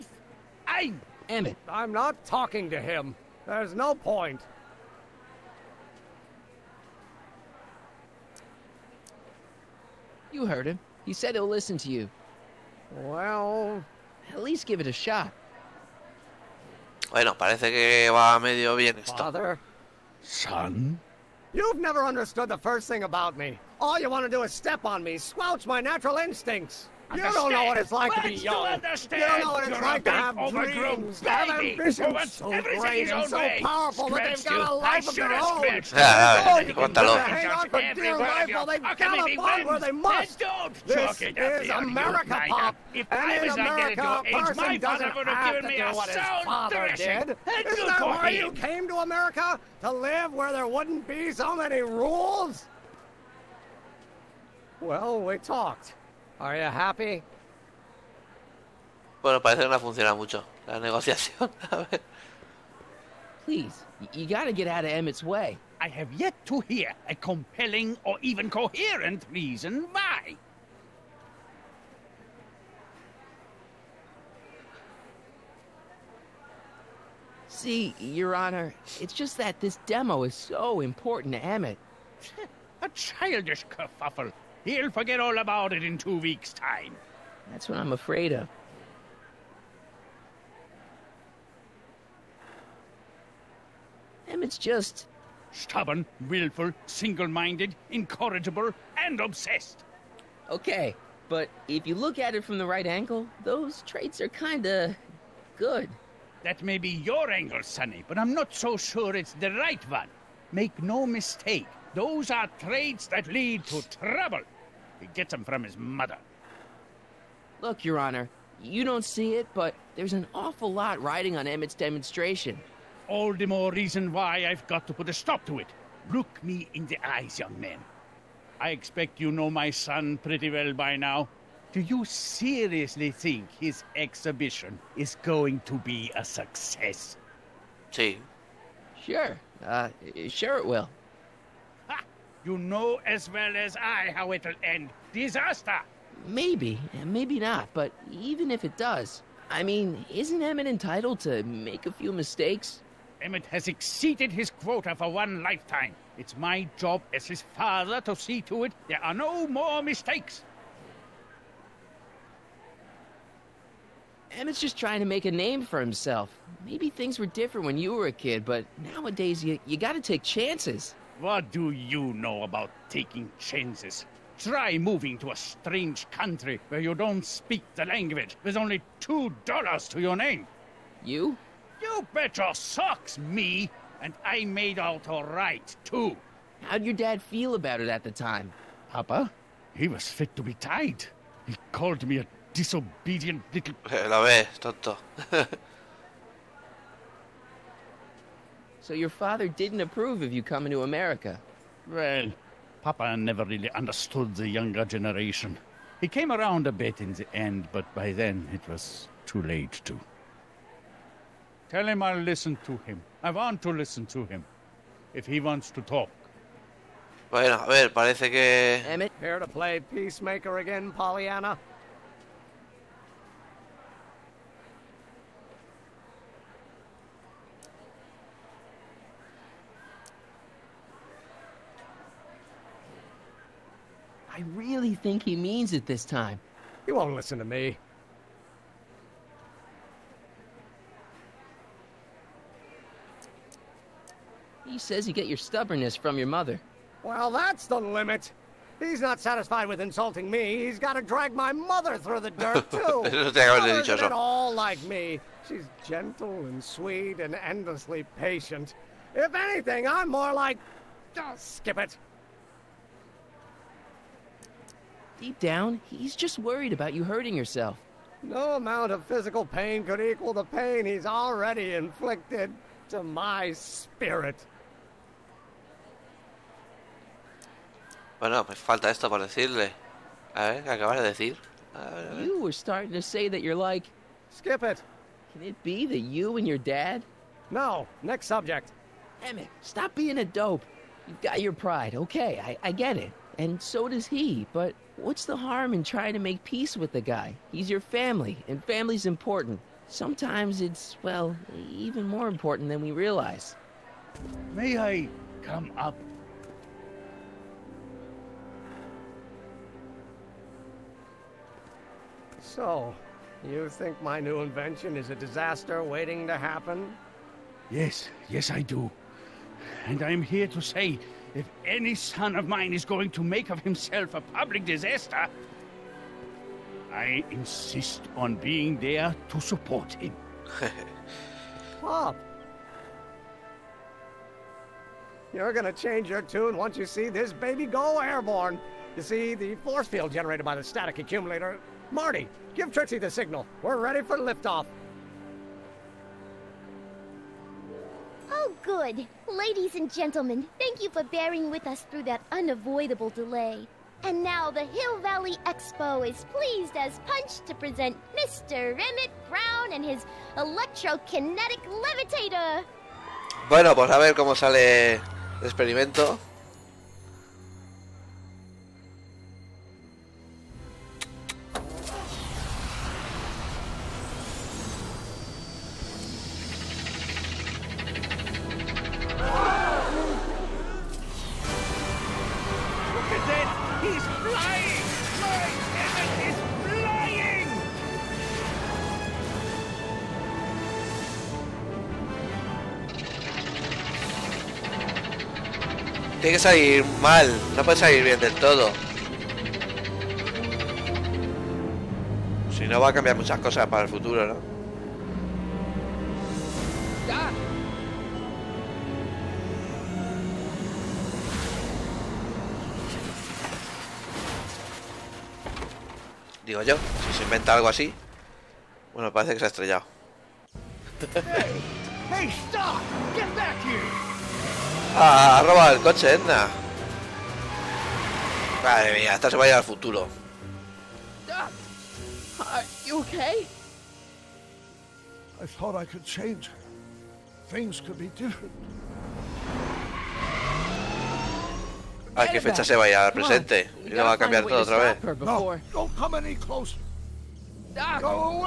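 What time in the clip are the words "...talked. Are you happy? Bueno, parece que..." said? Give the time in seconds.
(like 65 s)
55 s.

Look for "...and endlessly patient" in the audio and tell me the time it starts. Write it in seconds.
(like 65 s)
257 s.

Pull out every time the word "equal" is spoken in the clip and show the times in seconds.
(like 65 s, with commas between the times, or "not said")
269 s.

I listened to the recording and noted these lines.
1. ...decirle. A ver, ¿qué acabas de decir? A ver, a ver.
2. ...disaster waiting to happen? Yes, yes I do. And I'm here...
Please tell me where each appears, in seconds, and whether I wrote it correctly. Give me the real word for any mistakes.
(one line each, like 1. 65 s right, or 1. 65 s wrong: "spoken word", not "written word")
1. 279 s right
2. 315 s right.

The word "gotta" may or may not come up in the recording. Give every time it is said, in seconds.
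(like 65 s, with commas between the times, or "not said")
64 s, 169 s.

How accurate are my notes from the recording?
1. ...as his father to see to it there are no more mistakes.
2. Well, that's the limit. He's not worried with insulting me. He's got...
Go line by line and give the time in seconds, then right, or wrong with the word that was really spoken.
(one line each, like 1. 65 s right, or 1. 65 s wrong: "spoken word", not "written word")
1. 157 s right
2. 247 s wrong: "satisfied", not "worried".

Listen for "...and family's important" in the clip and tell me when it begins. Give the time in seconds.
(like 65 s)
298 s.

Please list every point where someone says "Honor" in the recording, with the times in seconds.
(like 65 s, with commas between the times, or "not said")
78 s, 117 s.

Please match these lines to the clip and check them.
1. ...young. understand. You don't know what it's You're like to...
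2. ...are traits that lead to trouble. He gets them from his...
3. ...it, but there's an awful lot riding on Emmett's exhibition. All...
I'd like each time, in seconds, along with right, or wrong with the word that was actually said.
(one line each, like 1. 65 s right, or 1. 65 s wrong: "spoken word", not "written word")
1. 28 s right
2. 112 s right
3. 119 s wrong: "demonstration", not "exhibition".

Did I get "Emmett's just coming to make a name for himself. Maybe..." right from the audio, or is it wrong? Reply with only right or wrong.
wrong.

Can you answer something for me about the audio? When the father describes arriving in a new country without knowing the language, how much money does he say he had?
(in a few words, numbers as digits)
$2.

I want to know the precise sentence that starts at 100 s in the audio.
Okay, but if you look at it from the right angle, those traits are kinda...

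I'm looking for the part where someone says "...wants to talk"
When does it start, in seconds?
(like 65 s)
215 s.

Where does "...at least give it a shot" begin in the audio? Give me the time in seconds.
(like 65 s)
14 s.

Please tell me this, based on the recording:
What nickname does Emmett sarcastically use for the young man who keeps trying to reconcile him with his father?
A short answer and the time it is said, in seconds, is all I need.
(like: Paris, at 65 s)
Pollyanna, at 220 s.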